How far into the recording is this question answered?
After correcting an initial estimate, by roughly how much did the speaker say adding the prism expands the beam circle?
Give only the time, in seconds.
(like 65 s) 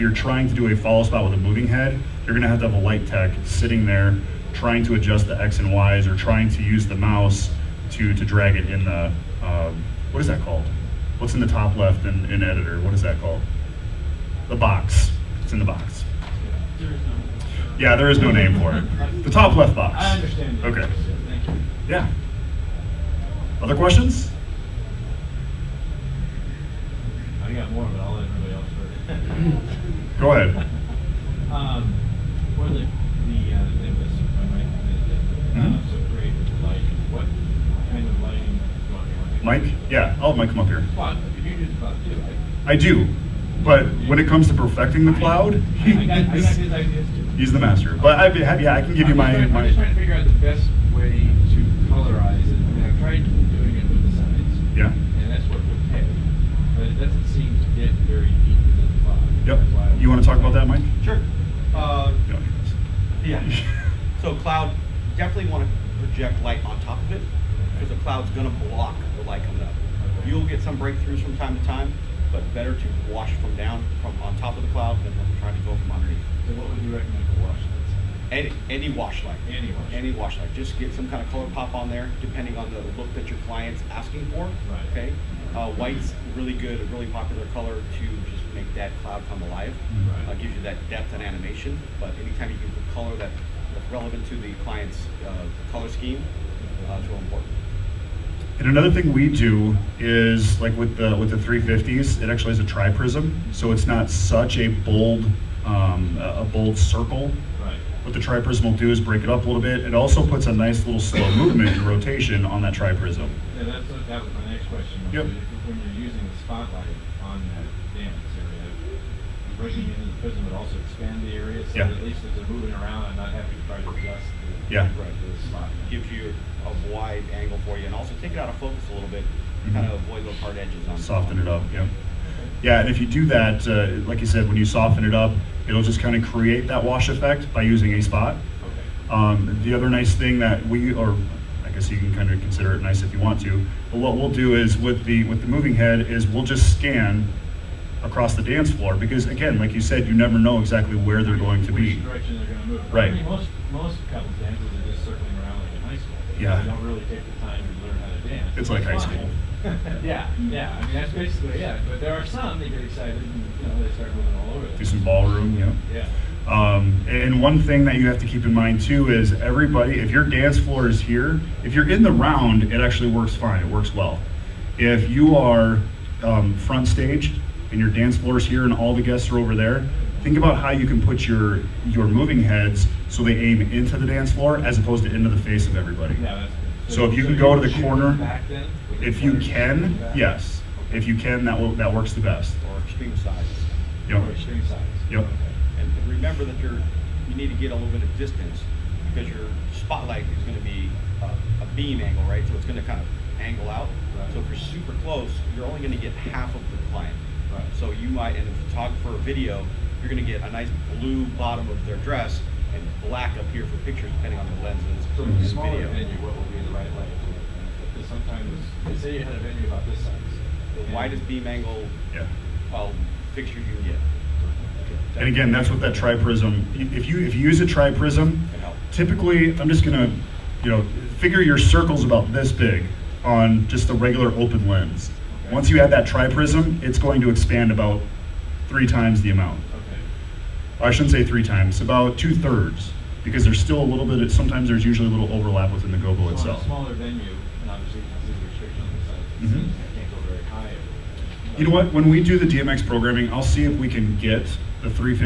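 241 s.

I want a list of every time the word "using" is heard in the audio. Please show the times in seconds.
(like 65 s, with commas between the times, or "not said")
116 s, 137 s.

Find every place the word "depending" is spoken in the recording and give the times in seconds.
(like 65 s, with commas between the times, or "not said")
82 s, 214 s.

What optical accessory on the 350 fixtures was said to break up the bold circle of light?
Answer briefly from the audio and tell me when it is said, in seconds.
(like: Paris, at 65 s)
Tri-prism, at 102 s.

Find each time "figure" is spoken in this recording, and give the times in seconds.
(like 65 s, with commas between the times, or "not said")
49 s, 231 s.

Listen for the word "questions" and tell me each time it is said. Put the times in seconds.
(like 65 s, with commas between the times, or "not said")
23 s, 114 s.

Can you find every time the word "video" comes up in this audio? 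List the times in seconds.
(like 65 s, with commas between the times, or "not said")
209 s, 215 s.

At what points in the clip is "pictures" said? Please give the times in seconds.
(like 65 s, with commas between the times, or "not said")
213 s, 223 s.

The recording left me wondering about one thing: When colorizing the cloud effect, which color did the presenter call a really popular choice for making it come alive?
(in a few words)
White.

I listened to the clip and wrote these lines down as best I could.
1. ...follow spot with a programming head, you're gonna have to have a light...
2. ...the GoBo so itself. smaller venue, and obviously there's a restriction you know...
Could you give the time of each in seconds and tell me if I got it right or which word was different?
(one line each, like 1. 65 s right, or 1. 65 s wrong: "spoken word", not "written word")
1. 0 s wrong: "moving", not "programming"
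2. 245 s right.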